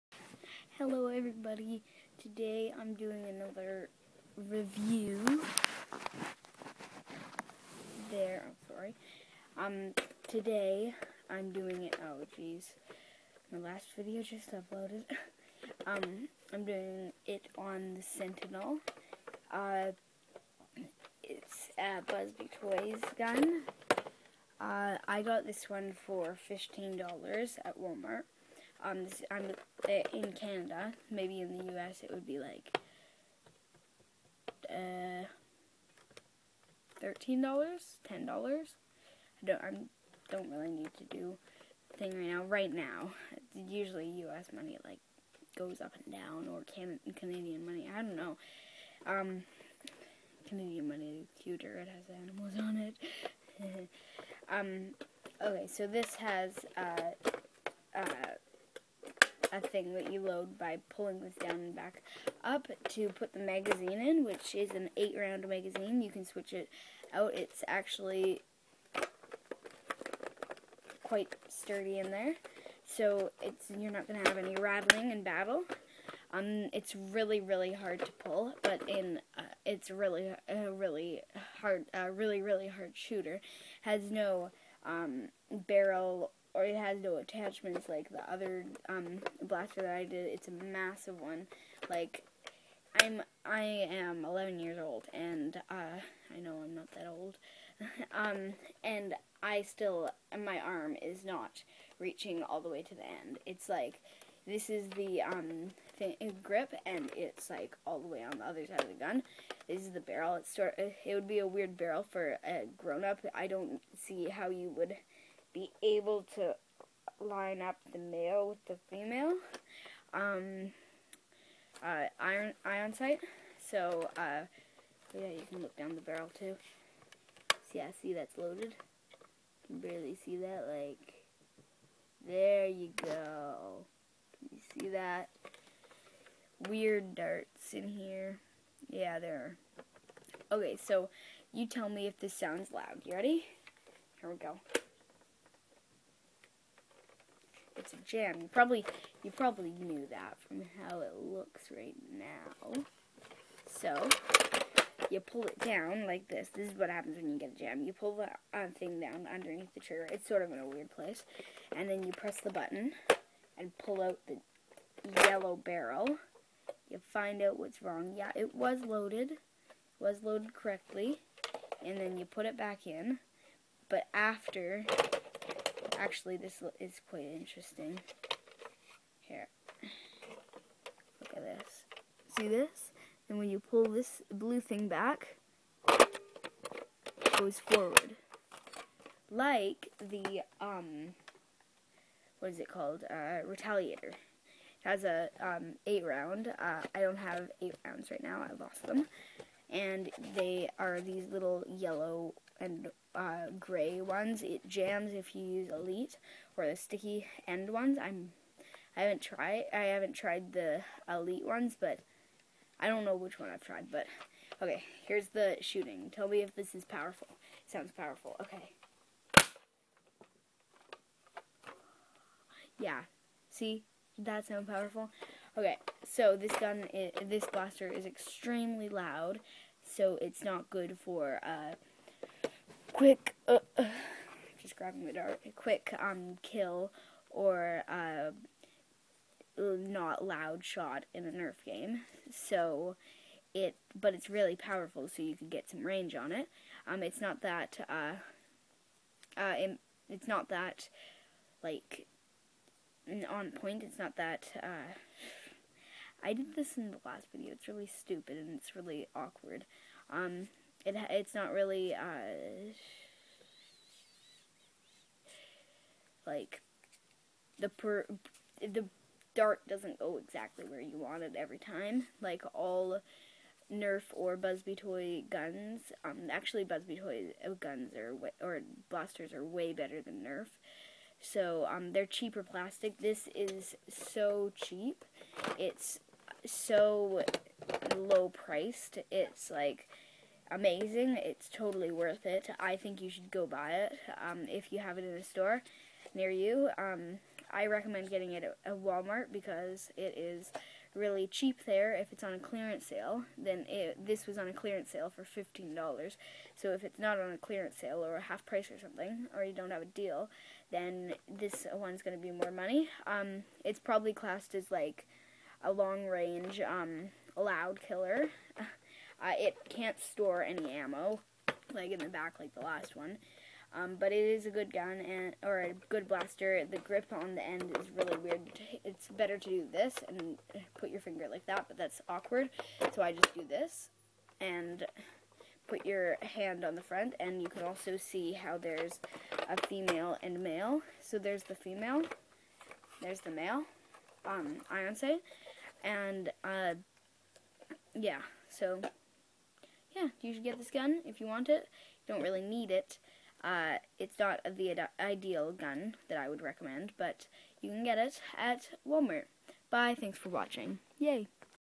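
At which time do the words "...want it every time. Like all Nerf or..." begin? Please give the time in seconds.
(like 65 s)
270 s.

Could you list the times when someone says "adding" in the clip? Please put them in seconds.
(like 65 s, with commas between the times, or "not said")
not said.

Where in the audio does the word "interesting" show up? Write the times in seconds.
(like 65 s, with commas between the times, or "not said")
177 s.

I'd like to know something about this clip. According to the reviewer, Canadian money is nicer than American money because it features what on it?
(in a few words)
Animals.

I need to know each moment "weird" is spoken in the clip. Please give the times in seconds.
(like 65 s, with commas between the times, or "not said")
111 s, 136 s, 160 s, 328 s.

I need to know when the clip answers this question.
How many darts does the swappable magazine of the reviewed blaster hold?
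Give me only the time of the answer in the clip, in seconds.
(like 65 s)
64 s.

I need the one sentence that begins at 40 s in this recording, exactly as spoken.
I don't really need to do thing right now.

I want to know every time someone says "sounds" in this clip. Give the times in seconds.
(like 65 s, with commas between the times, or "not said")
142 s, 217 s, 224 s.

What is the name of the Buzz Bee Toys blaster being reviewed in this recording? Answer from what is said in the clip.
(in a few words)
Sentinel.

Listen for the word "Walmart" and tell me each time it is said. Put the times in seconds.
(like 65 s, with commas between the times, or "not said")
27 s, 298 s, 358 s.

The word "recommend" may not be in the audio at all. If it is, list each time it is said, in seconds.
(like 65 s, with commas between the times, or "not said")
297 s, 356 s.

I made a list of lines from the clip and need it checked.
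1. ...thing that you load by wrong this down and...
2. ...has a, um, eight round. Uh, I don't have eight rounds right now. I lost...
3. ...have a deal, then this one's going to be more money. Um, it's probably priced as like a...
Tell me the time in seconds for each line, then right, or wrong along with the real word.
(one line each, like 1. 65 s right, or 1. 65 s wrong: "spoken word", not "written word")
1. 59 s wrong: "pulling", not "wrong"
2. 194 s right
3. 309 s wrong: "classed", not "priced".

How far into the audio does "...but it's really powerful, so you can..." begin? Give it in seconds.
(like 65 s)
243 s.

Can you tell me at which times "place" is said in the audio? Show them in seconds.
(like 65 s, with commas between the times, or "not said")
160 s.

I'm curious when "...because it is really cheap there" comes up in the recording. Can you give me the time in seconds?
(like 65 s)
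299 s.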